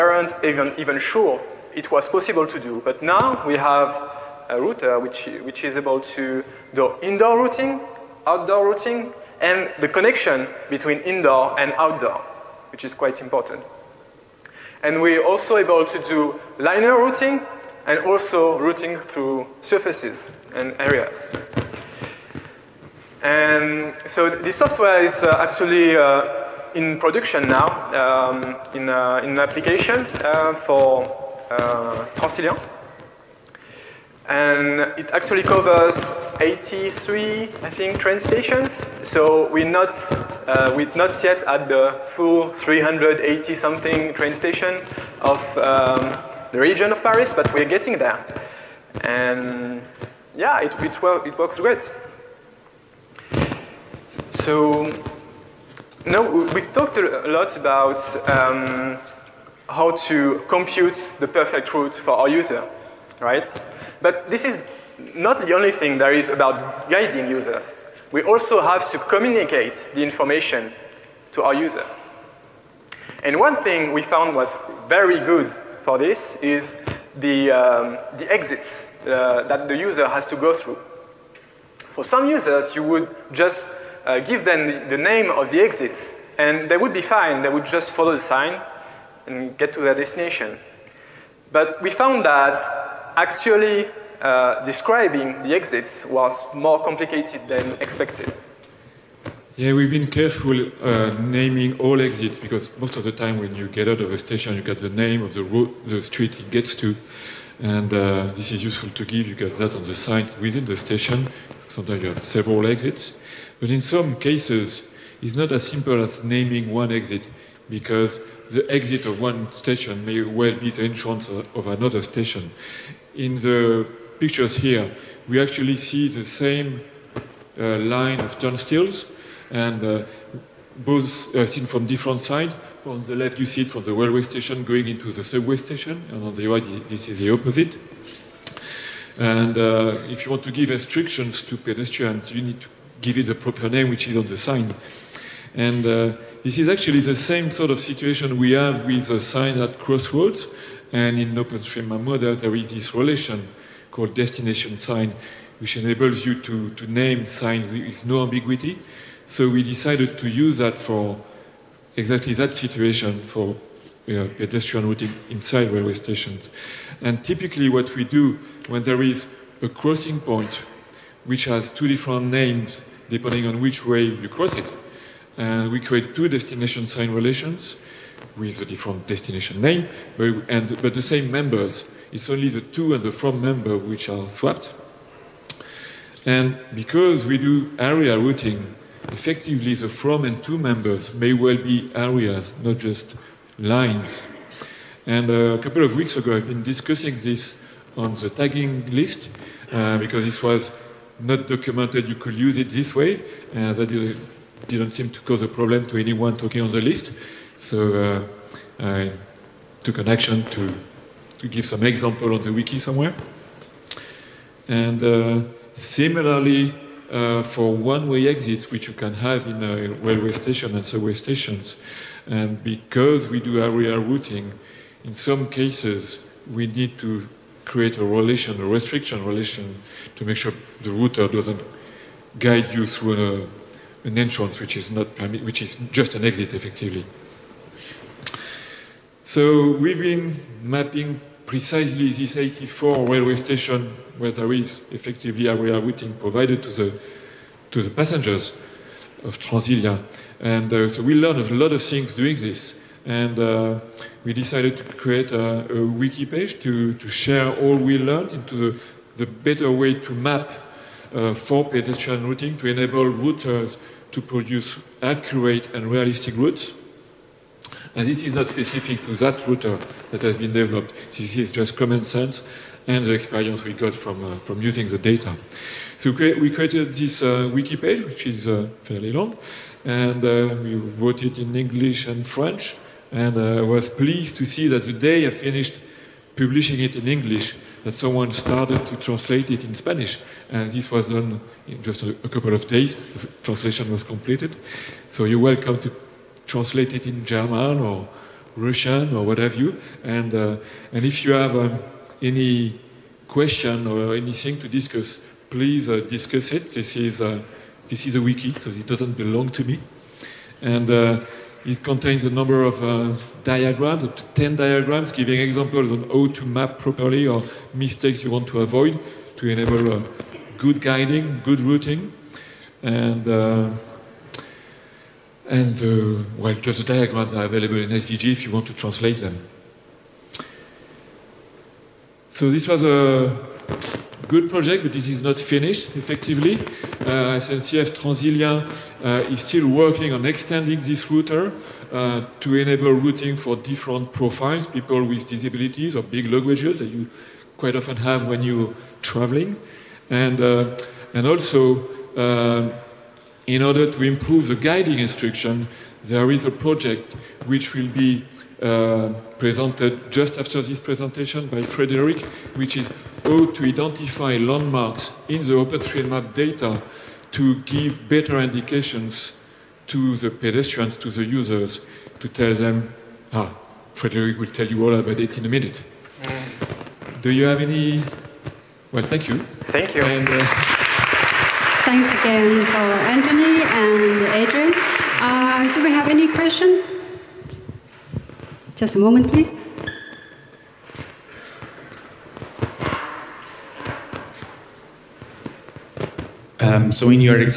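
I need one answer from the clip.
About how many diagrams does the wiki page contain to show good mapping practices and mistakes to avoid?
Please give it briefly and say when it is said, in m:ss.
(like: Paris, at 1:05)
10, at 5:14.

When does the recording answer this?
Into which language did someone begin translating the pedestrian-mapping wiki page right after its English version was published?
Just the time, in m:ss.
4:49.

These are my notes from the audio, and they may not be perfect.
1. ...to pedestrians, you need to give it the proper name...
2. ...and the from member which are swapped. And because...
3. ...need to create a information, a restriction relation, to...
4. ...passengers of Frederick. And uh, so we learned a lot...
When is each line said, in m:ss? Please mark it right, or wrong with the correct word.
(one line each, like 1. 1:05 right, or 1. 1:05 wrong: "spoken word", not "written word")
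1. 2:21 right
2. 3:02 right
3. 3:46 wrong: "relation", not "information"
4. 4:07 wrong: "Transilien", not "Frederick".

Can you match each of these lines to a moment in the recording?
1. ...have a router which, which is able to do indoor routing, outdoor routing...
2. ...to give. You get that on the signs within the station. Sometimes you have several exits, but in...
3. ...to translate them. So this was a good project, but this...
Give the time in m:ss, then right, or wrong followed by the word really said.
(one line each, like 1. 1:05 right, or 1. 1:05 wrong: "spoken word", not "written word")
1. 0:03 right
2. 1:48 right
3. 5:28 right.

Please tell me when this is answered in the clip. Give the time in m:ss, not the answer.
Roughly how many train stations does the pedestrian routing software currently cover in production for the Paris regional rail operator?
0:36.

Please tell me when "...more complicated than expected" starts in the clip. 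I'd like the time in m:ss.
1:36.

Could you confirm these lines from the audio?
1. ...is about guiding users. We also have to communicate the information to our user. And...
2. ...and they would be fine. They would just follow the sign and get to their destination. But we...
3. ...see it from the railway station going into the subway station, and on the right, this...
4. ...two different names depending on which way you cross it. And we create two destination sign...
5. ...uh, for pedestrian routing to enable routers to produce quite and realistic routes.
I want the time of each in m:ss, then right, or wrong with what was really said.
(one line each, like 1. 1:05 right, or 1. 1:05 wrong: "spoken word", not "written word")
1. 1:06 right
2. 1:26 right
3. 2:13 right
4. 2:51 right
5. 4:21 wrong: "accurate", not "quite".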